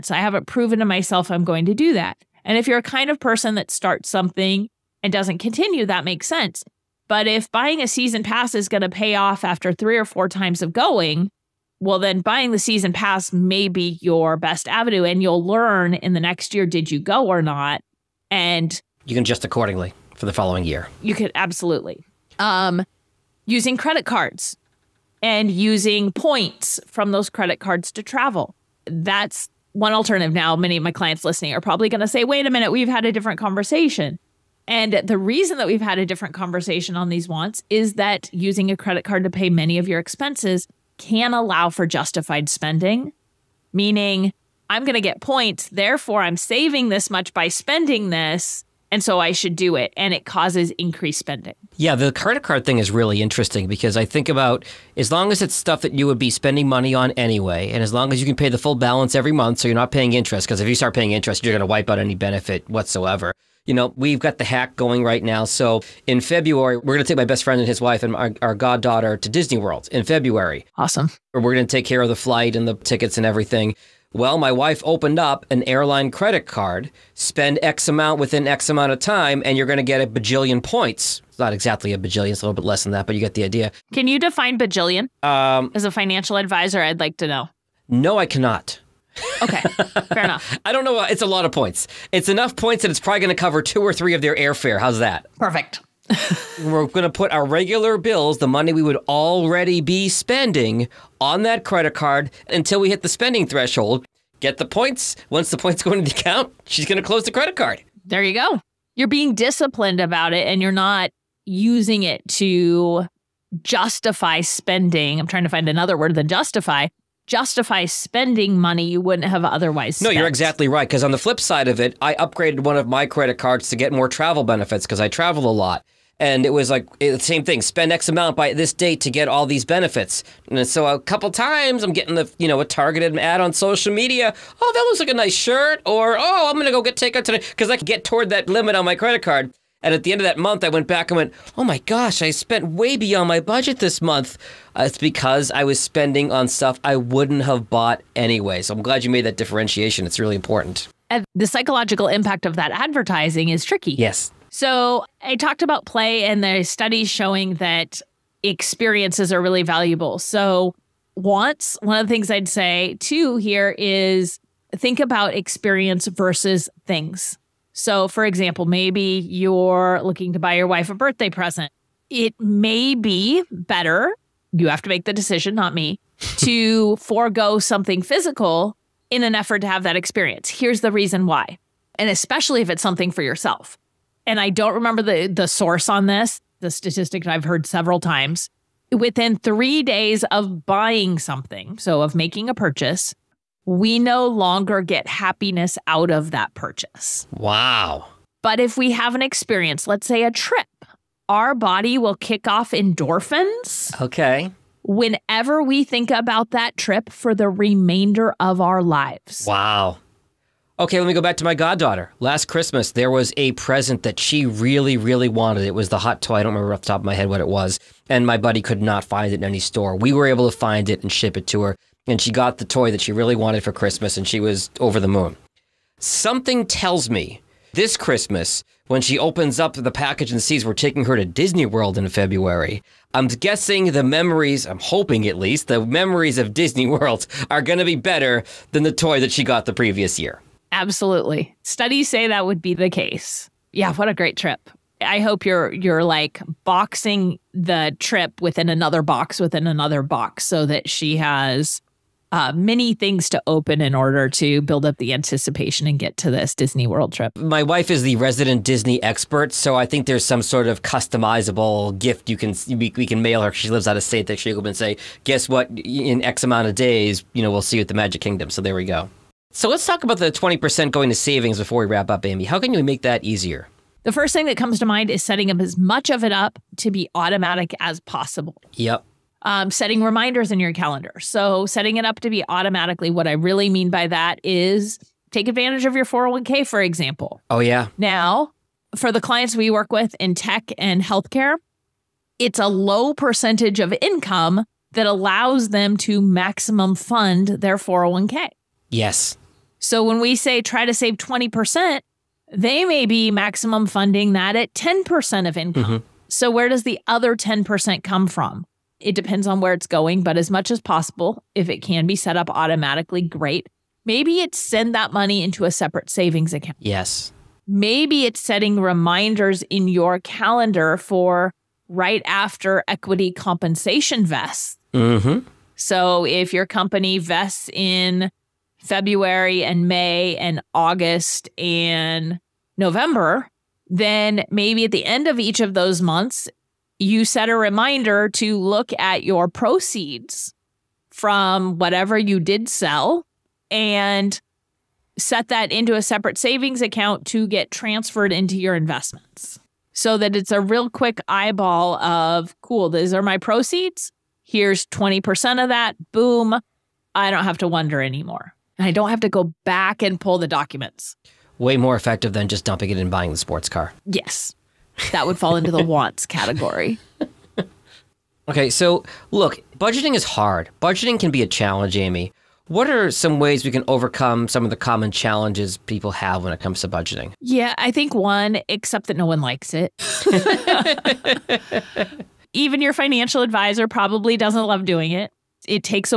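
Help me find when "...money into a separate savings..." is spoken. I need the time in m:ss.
5:15.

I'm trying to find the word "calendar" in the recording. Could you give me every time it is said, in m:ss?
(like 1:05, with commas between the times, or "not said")
4:40, 5:20.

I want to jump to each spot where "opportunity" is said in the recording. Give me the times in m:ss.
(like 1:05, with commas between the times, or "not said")
not said.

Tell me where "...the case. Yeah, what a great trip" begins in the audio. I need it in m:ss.
4:02.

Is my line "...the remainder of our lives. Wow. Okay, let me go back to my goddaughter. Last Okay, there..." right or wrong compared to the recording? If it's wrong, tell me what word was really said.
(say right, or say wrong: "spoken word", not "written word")
wrong: "Christmas", not "Okay".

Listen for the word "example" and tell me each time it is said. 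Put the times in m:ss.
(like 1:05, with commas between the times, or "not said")
2:48, 4:46.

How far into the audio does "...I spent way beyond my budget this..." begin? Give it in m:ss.
2:22.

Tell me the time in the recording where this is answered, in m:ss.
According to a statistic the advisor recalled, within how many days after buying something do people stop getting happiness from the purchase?
3:09.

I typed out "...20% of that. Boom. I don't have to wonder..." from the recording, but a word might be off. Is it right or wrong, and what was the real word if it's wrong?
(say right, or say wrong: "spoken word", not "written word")
right.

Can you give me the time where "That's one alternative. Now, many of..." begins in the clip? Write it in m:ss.
0:28.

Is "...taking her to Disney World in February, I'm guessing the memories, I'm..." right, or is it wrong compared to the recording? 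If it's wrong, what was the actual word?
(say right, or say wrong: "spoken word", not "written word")
right.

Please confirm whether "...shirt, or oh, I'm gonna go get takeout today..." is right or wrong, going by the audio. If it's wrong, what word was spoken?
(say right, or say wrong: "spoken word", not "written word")
right.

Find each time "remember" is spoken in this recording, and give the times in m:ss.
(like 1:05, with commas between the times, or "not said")
3:04, 3:36.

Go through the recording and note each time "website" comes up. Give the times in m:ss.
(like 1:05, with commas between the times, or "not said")
not said.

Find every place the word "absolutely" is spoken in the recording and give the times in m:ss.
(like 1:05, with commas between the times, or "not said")
0:21, 4:00.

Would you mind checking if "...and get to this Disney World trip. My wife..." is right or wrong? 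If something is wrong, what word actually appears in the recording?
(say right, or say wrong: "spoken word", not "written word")
right.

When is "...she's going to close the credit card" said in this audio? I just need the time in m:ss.
1:46.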